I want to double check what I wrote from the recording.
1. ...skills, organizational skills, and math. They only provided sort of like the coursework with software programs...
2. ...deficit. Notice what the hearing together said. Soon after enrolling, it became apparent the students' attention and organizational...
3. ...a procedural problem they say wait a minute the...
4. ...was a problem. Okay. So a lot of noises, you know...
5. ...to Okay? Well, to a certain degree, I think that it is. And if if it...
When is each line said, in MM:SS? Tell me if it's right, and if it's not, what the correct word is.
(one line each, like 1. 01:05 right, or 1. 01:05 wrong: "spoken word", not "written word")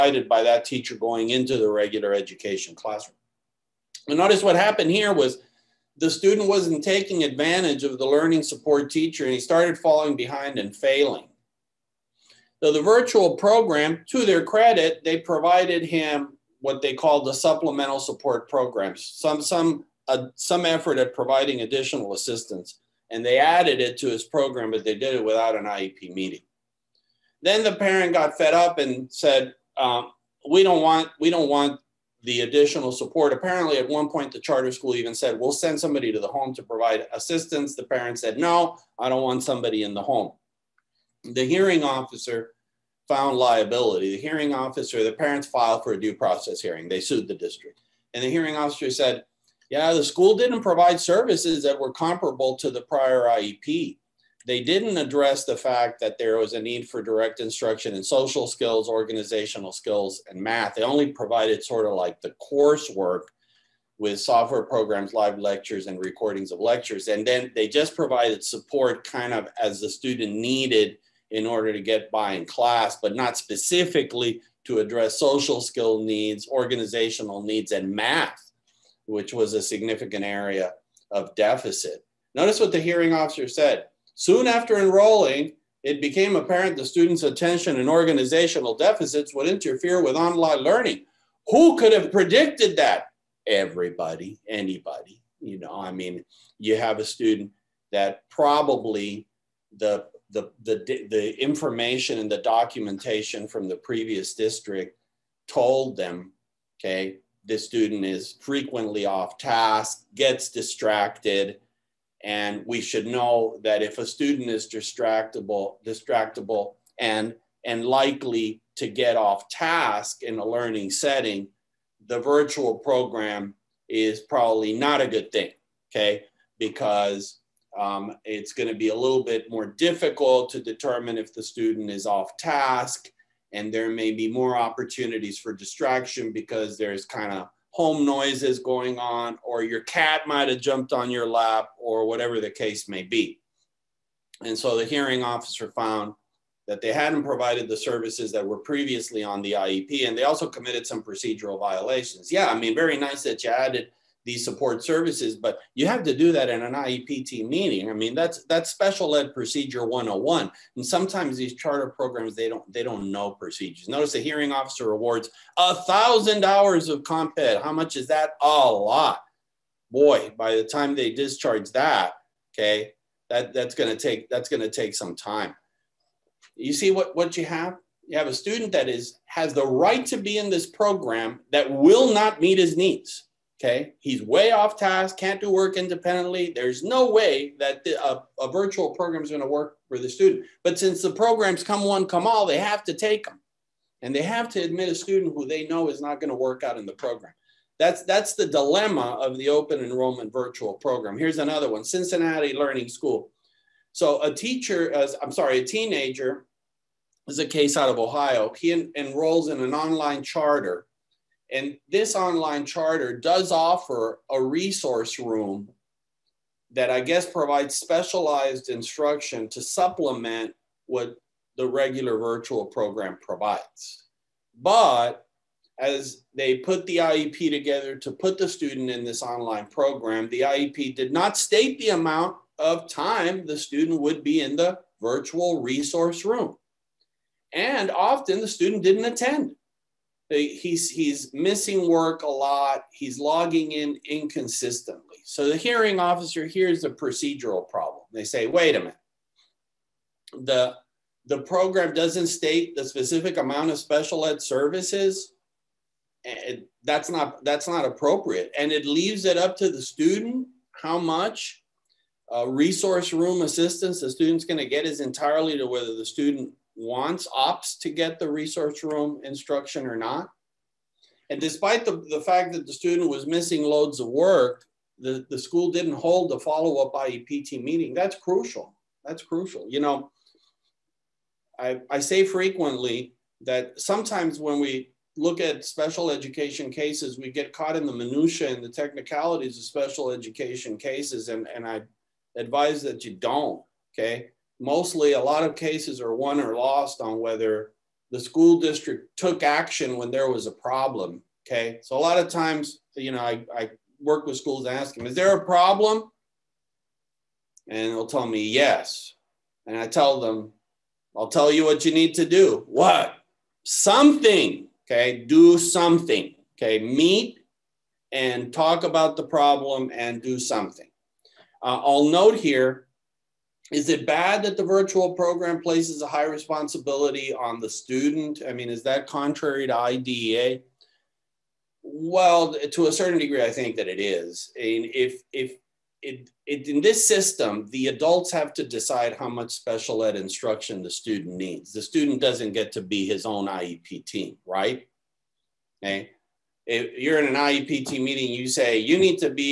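1. 00:58 right
2. 01:21 wrong: "officer", not "together"
3. 04:06 right
4. 05:00 wrong: "times", not "noises"
5. 05:29 wrong: "IDEA", not "Okay".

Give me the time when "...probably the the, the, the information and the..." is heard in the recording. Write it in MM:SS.
01:38.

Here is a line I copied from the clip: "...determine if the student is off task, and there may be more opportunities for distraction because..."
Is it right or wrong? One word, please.
right.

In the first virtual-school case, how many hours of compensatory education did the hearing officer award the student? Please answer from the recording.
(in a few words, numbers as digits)
1000.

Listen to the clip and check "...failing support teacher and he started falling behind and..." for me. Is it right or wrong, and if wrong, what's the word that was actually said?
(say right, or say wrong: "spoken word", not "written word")
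wrong: "learning", not "failing".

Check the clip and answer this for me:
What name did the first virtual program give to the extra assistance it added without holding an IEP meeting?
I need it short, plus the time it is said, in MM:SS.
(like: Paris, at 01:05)
Supplemental support programs, at 00:17.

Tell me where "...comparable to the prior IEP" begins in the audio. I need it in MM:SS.
00:51.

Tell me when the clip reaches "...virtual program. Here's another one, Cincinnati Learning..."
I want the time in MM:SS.
03:20.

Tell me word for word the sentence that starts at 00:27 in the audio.
Then the parent got fed up and said, um, we don't want, we don't want the additional support.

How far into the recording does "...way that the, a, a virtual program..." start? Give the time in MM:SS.
03:07.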